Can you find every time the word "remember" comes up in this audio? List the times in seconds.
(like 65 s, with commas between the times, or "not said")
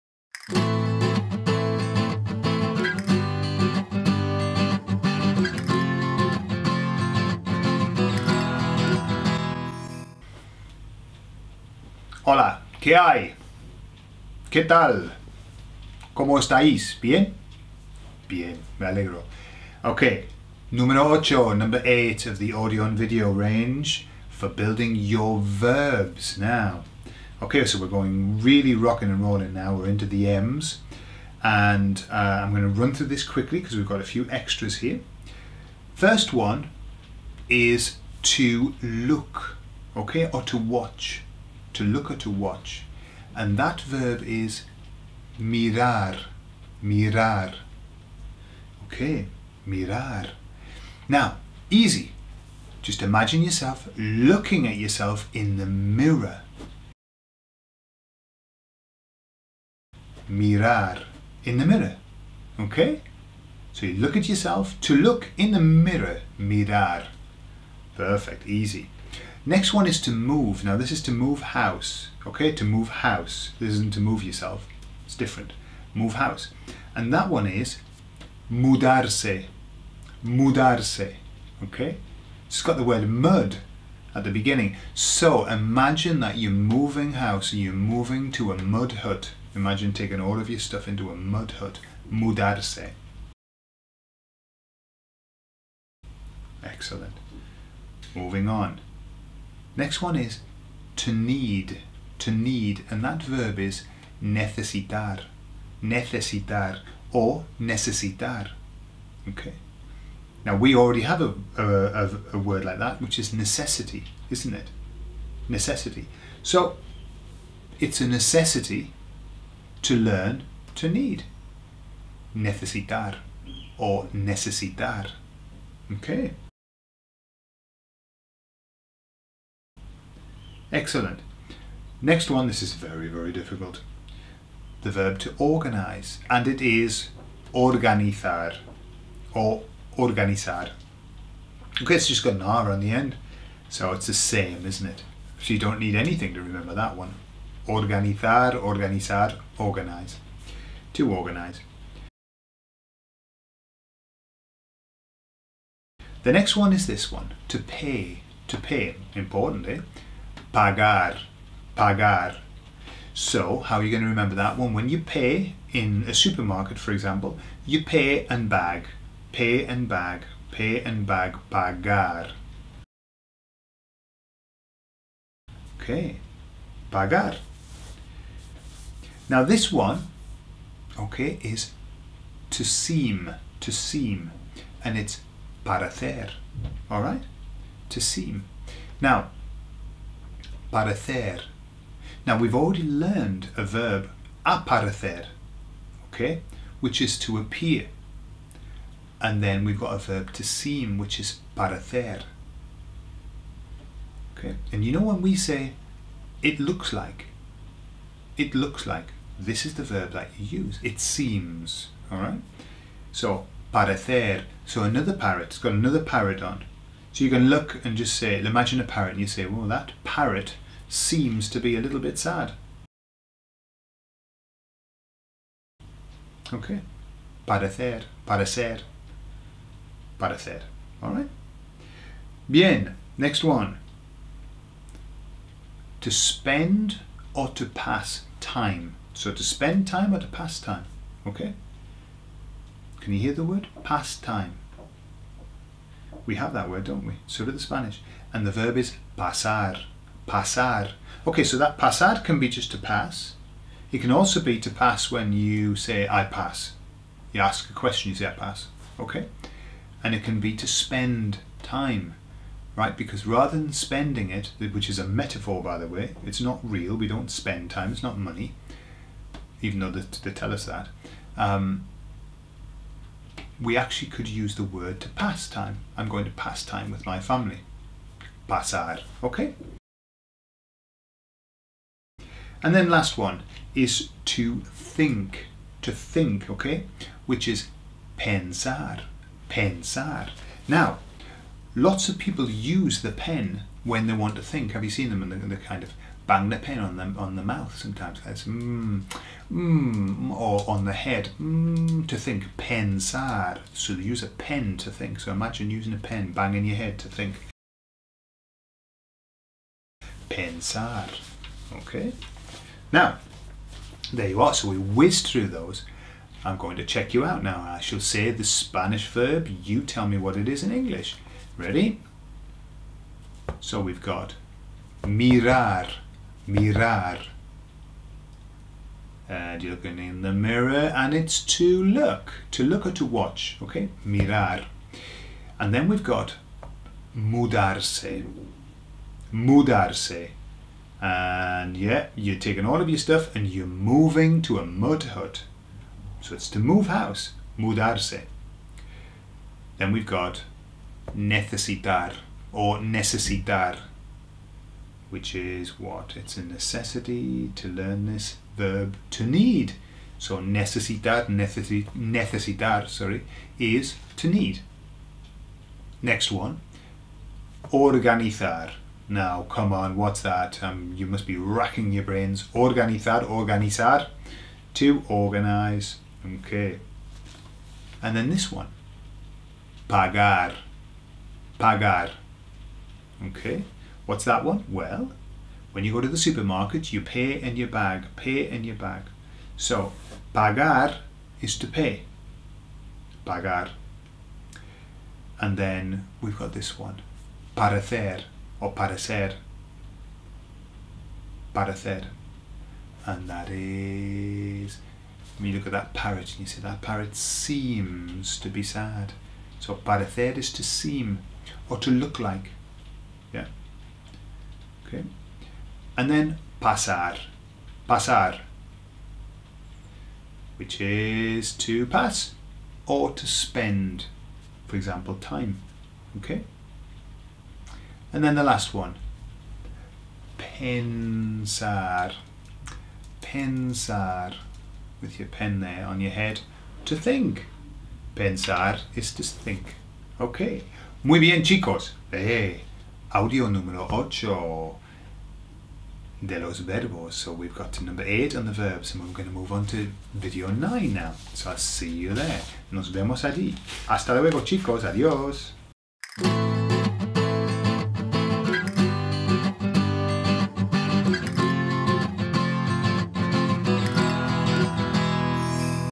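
146 s, 164 s.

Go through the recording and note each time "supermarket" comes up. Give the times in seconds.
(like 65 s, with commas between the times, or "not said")
166 s, 386 s.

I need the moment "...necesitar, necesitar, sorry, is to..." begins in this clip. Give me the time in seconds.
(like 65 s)
360 s.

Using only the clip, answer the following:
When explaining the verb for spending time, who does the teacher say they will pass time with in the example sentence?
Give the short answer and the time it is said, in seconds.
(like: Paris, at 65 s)
my family, at 277 s.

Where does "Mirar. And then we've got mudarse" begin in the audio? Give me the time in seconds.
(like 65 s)
334 s.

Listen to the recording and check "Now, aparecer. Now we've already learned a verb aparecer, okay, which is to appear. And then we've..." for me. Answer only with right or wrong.
right.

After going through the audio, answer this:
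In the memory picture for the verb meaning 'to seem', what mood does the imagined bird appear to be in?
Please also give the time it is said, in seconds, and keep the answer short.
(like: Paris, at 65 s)
a little bit sad, at 221 s.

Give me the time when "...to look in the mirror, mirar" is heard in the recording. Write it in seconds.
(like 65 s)
64 s.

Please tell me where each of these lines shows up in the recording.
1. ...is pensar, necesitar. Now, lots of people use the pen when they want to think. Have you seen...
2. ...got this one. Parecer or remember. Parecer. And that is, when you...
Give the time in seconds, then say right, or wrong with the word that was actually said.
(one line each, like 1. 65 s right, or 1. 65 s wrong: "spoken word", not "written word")
1. 287 s wrong: "pensar", not "necesitar"
2. 396 s wrong: "parecer", not "remember".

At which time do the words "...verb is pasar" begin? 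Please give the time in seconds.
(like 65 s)
248 s.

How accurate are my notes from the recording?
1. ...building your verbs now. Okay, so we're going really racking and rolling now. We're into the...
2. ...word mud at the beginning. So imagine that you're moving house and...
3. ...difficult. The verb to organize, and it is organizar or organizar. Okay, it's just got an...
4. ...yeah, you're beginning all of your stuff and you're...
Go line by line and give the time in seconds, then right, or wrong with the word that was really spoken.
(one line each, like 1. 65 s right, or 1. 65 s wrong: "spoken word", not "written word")
1. 24 s wrong: "rocking", not "racking"
2. 82 s right
3. 133 s right
4. 341 s wrong: "taking", not "beginning".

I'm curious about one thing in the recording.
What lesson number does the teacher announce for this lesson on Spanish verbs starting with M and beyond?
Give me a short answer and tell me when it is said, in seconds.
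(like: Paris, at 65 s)
8, at 20 s.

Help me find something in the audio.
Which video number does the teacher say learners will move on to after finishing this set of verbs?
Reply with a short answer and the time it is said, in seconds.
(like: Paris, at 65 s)
9, at 450 s.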